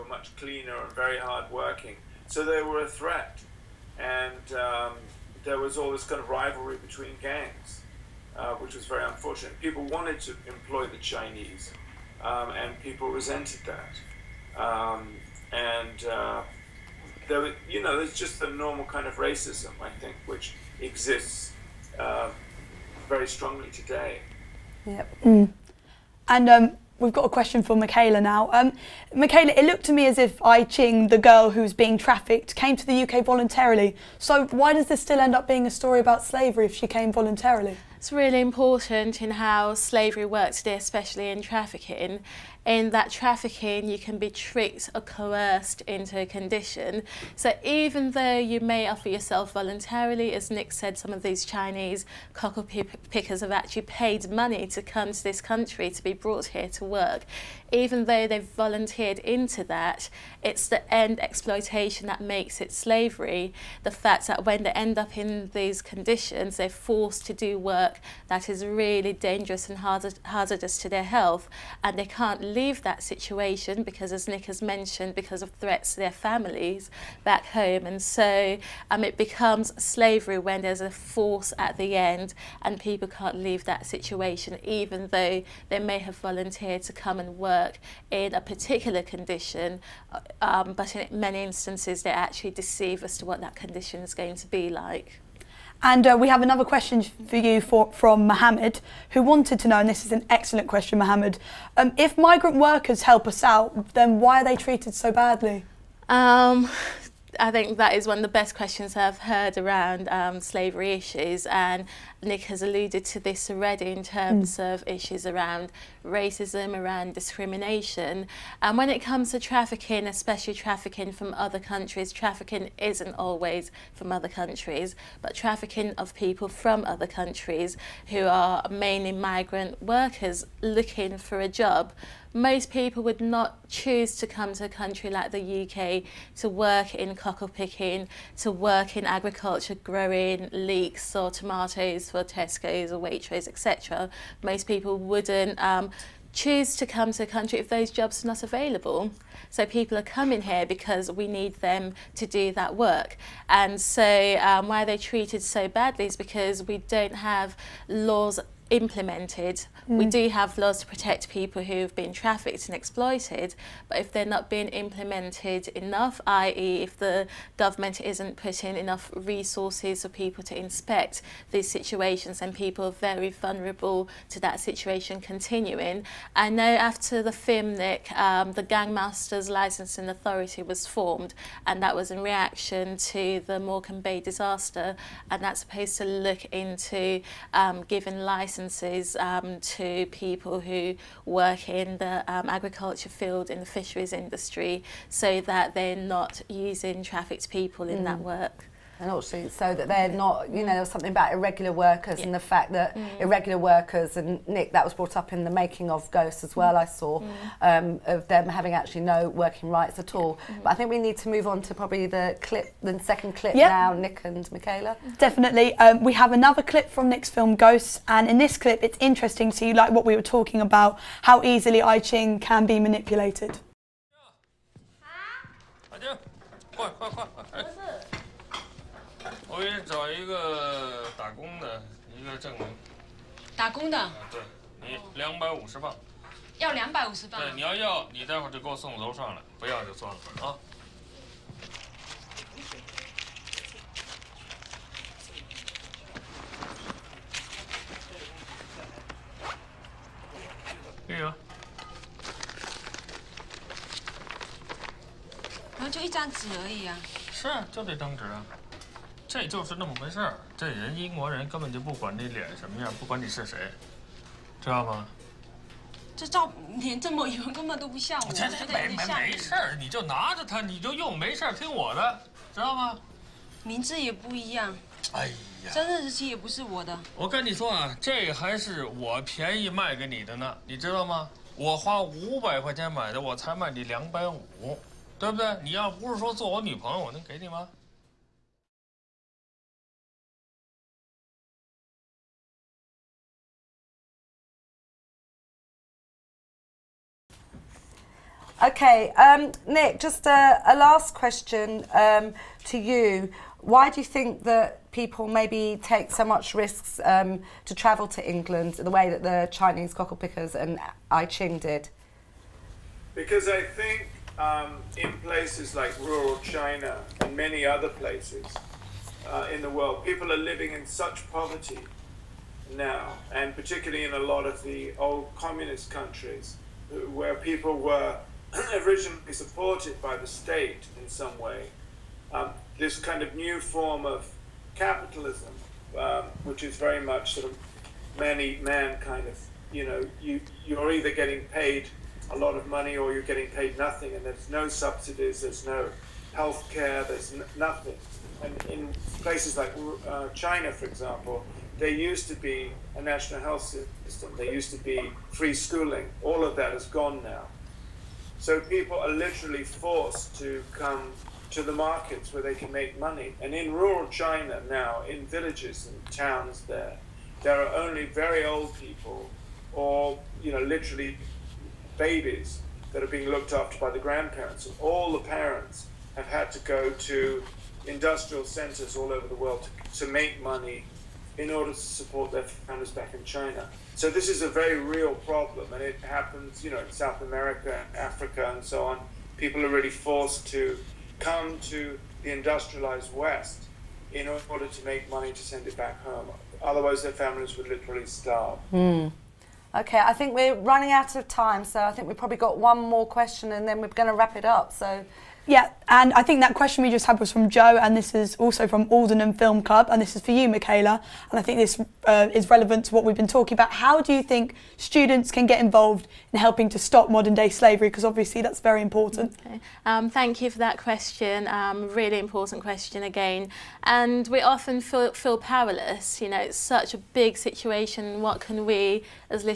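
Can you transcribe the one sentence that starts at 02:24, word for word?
Most people wouldn't um, choose to come to a country if those jobs are not available.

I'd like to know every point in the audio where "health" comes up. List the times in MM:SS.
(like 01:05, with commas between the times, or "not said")
01:11, 05:46, 05:53.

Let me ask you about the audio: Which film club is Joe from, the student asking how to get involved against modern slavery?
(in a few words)
Aldenham Film Club.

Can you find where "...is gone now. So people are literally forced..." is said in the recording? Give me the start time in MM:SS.
05:56.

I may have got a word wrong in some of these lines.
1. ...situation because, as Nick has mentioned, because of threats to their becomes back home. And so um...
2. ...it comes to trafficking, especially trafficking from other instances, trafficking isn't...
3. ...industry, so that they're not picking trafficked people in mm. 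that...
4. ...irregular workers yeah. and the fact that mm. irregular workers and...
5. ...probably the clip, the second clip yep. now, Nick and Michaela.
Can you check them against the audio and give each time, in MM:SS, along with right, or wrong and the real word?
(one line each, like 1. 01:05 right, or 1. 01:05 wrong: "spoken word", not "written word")
1. 01:13 wrong: "families", not "becomes"
2. 01:58 wrong: "countries", not "instances"
3. 03:14 wrong: "using", not "picking"
4. 03:21 right
5. 03:31 right.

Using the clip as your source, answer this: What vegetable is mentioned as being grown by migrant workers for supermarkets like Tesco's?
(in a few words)
Leeks.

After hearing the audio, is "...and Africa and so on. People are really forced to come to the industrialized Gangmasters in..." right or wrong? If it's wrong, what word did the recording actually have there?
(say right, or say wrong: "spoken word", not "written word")
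wrong: "West", not "Gangmasters".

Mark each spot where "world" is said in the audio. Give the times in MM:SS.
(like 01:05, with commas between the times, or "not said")
05:19, 06:19.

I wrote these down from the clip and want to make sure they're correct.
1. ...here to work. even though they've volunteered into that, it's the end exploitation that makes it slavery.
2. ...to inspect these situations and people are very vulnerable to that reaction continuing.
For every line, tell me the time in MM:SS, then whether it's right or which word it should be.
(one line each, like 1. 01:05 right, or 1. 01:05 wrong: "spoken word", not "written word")
1. 00:56 right
2. 02:50 wrong: "situation", not "reaction".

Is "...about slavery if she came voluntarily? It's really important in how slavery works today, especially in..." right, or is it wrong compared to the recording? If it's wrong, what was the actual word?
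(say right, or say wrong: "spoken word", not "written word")
right.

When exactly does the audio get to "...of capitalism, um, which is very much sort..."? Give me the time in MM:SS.
05:34.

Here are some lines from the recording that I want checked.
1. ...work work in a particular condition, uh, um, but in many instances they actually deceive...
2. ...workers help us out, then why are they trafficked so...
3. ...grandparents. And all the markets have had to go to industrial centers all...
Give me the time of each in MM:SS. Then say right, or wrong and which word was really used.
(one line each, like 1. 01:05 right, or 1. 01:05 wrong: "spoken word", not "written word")
1. 01:27 right
2. 01:42 wrong: "treated", not "trafficked"
3. 06:13 wrong: "parents", not "markets".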